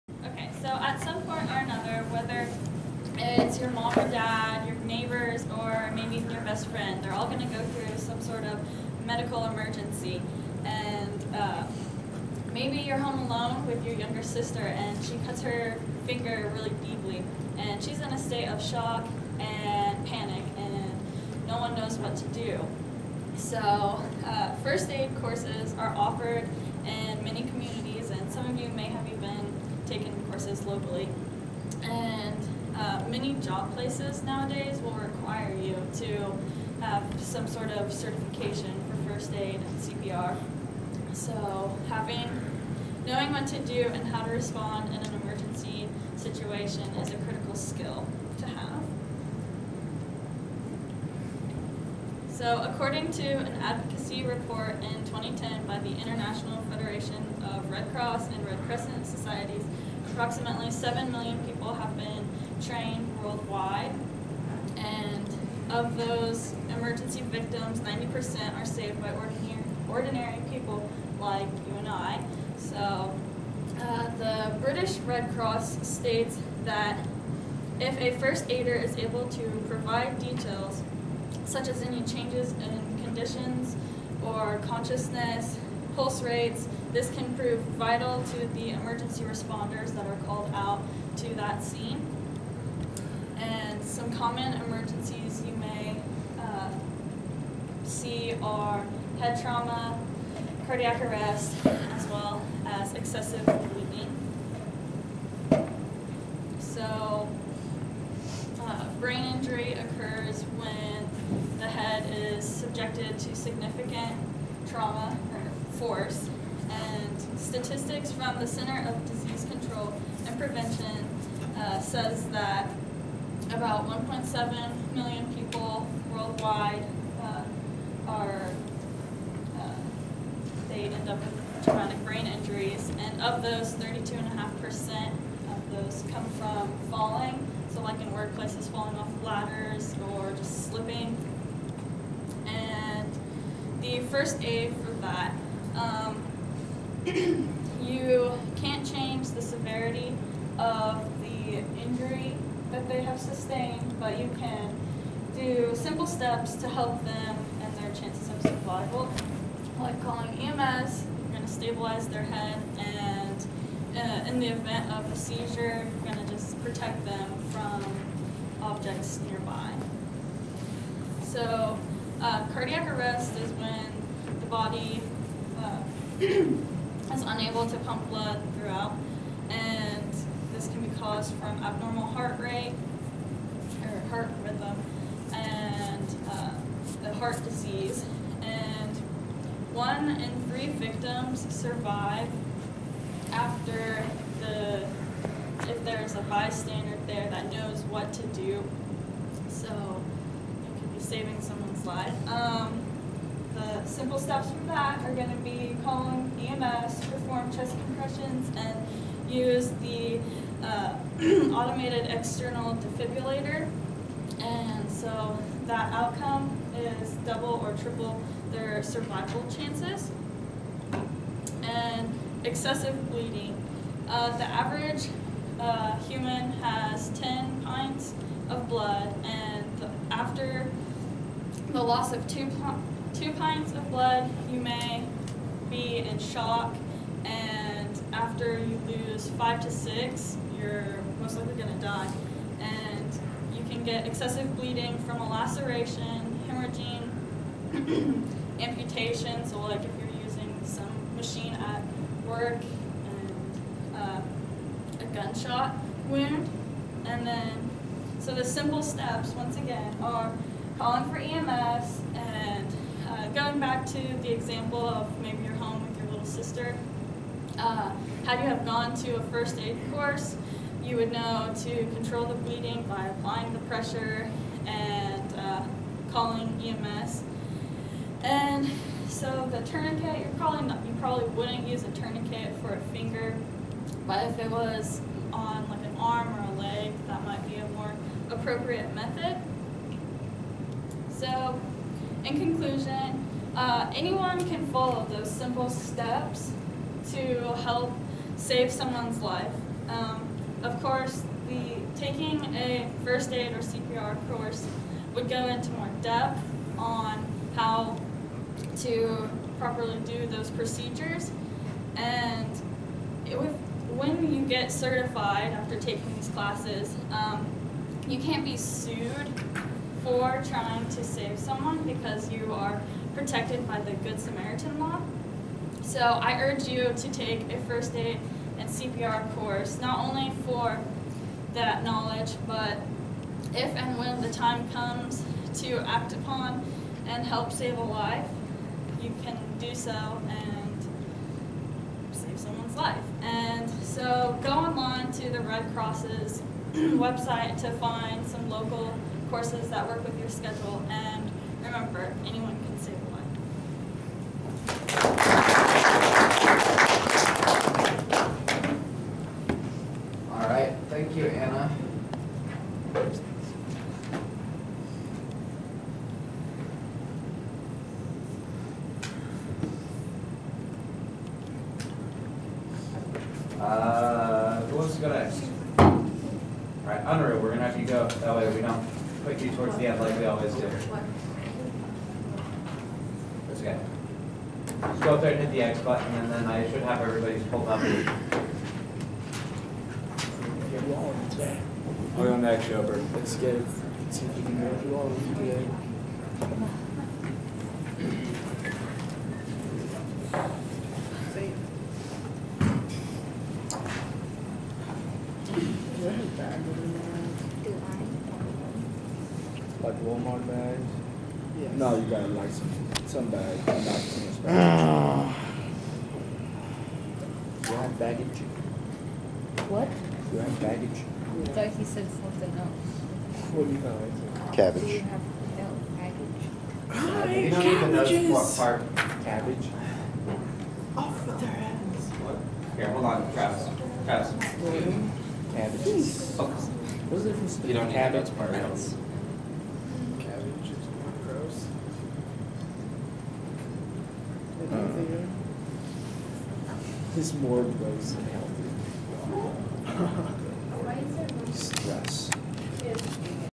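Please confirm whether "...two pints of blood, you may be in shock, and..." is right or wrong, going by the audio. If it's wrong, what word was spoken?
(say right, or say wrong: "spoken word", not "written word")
right.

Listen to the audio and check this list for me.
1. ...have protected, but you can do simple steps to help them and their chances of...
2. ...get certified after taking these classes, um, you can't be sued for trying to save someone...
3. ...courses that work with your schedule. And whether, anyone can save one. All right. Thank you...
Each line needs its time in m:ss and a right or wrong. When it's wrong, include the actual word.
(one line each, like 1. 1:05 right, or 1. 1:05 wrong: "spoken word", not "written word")
1. 2:33 wrong: "sustained", not "protected"
2. 5:14 right
3. 5:49 wrong: "remember", not "whether".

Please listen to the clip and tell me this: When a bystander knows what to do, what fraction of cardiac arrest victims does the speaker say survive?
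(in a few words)
one in three.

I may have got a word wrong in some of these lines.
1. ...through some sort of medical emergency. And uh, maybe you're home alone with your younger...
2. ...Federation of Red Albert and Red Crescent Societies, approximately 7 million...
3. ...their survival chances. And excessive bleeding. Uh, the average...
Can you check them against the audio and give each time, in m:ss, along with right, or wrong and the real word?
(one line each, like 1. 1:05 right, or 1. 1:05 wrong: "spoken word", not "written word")
1. 0:07 right
2. 0:56 wrong: "Cross", not "Albert"
3. 3:38 right.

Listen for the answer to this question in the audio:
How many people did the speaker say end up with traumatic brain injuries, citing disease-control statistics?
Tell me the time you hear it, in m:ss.
2:03.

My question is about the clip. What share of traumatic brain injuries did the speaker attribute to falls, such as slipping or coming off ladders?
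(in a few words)
32.5%.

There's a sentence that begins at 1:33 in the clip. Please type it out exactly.
And some common emergencies you may uh, see are head trauma, cardiac arrest, as well as excessive bleeding.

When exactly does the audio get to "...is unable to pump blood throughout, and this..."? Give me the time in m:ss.
2:56.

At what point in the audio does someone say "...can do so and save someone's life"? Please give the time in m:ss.
5:39.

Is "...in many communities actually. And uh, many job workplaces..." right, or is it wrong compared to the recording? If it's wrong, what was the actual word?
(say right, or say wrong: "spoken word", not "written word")
wrong: "places", not "workplaces".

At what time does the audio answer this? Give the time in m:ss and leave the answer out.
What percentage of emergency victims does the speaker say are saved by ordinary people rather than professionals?
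1:07.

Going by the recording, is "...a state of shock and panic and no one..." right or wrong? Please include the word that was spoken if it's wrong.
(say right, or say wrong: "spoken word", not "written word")
right.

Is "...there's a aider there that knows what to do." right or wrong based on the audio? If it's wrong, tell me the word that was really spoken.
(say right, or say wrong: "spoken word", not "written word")
wrong: "bystander", not "aider".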